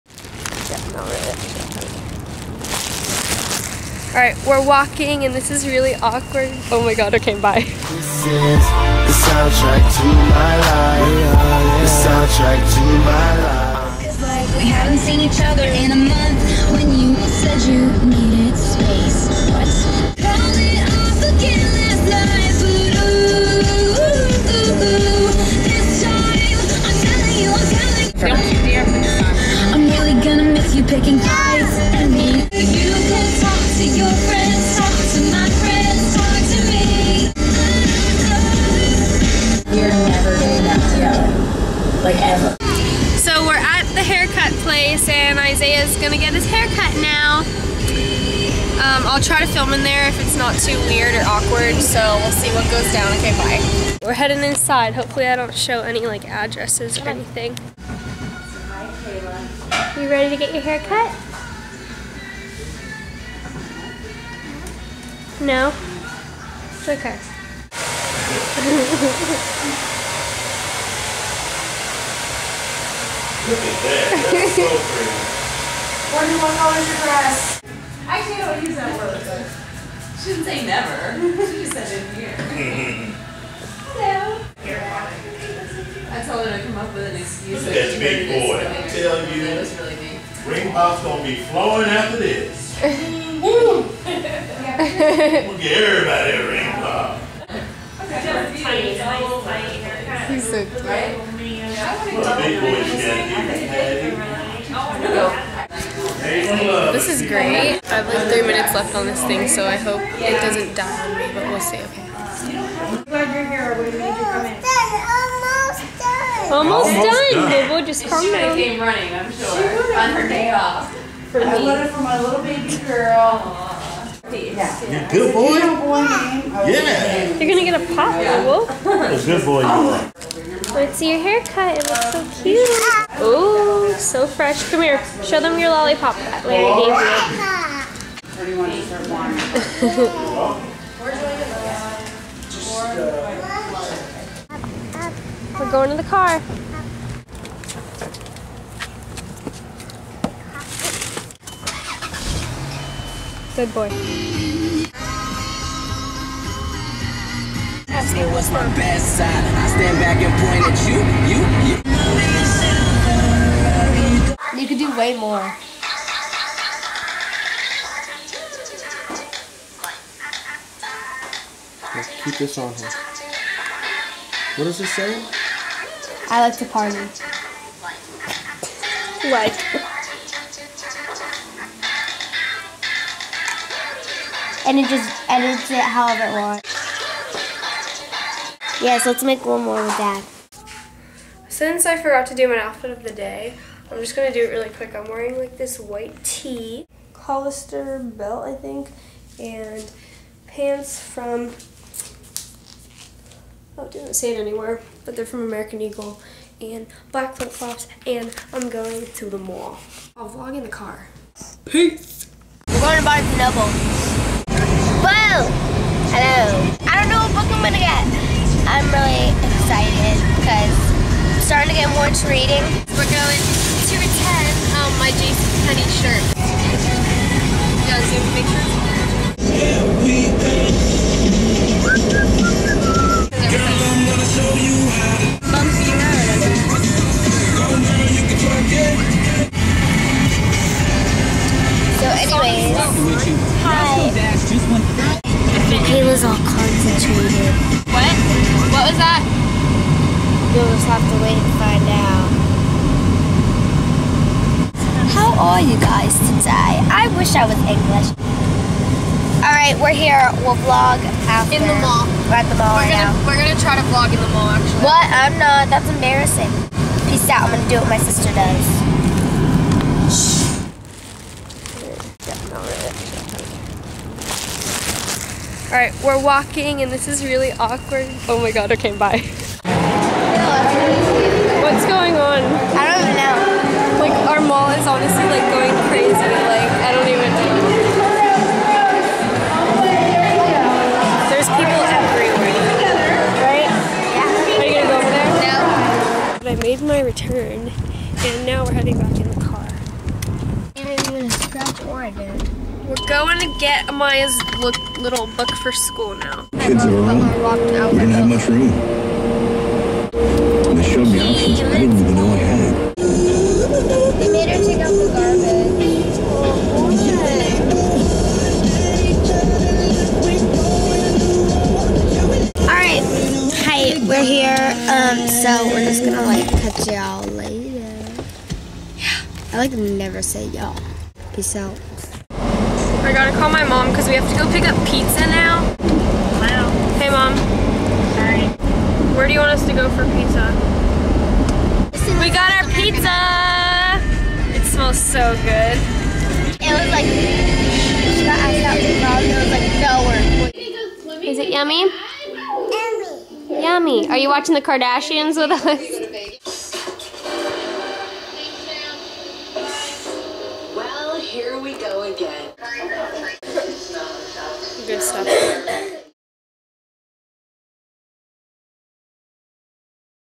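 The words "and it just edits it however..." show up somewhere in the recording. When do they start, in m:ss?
3:04.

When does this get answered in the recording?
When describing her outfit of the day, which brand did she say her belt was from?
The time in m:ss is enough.
3:17.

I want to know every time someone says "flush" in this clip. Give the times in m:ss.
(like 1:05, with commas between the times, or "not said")
not said.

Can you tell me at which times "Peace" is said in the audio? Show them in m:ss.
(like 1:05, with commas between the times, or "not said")
3:31, 4:27, 5:31.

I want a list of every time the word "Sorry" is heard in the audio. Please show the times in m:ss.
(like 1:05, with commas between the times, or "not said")
5:38.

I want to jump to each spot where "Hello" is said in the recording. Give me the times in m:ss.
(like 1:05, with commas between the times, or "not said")
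1:23, 3:36.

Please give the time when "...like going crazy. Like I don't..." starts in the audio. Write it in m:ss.
4:45.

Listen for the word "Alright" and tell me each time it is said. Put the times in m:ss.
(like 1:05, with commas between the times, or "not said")
0:04, 5:22.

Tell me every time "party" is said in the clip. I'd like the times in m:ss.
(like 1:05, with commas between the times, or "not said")
2:56.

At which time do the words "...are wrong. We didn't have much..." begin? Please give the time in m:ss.
5:06.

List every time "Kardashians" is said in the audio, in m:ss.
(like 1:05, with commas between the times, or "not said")
5:54.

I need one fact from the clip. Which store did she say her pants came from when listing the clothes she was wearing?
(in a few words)
American Eagle.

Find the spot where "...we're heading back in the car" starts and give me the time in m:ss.
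4:58.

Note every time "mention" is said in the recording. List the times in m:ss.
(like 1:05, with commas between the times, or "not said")
not said.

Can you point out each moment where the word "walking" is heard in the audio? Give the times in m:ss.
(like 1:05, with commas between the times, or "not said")
0:04, 4:36.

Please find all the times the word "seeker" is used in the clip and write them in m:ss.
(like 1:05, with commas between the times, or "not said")
not said.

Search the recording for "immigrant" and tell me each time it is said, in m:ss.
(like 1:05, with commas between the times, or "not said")
not said.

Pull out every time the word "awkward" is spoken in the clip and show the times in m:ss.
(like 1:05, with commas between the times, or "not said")
0:05, 0:51, 4:37.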